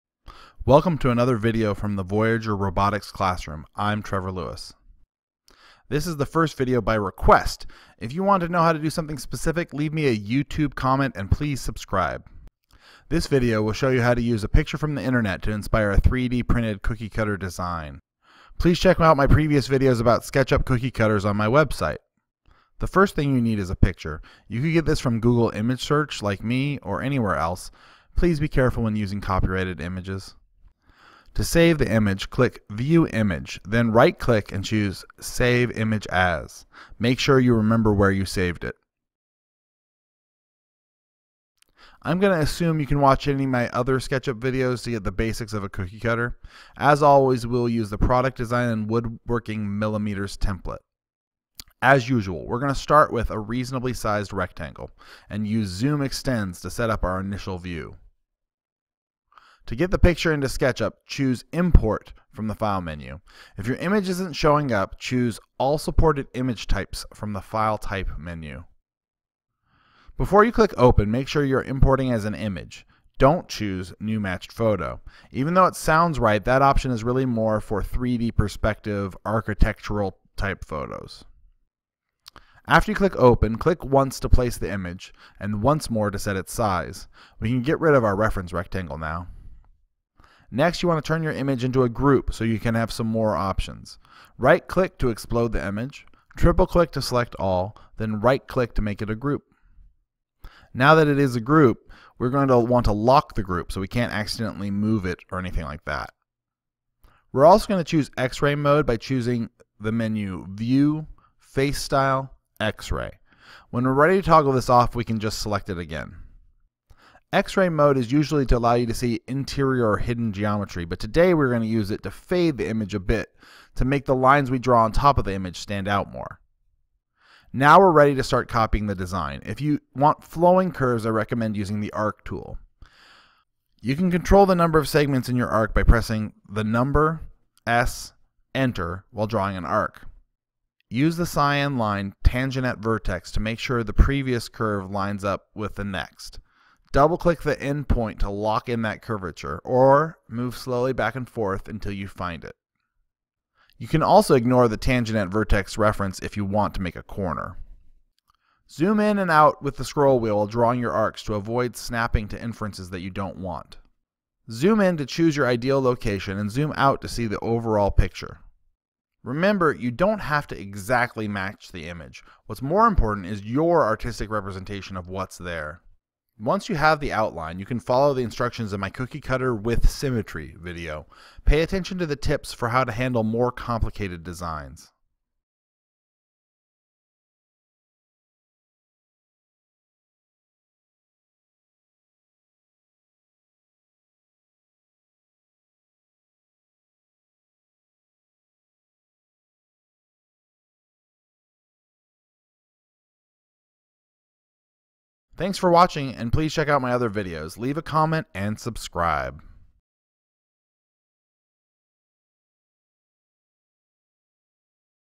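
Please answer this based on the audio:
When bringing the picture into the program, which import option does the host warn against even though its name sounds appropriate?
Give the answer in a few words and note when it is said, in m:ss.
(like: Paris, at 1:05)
New Matched Photo, at 1:14.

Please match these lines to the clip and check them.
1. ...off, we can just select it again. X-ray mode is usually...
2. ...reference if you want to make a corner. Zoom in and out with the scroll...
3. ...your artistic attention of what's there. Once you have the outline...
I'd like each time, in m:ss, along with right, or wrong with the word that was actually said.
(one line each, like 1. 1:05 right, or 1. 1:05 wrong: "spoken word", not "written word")
1. 1:54 right
2. 2:35 right
3. 2:53 wrong: "representation", not "attention".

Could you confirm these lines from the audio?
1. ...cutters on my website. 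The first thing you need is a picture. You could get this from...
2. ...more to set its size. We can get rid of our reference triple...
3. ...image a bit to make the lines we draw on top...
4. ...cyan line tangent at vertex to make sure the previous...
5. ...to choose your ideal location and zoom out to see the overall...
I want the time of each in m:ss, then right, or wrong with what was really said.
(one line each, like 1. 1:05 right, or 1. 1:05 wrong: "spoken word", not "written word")
1. 0:20 right
2. 1:25 wrong: "rectangle", not "triple"
3. 2:02 right
4. 2:21 right
5. 2:44 right.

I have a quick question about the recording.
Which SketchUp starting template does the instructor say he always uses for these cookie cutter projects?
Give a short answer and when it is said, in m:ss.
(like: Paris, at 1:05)
Product Design and Woodworking Millimeters, at 0:47.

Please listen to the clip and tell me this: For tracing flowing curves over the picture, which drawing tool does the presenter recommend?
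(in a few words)
arc tool.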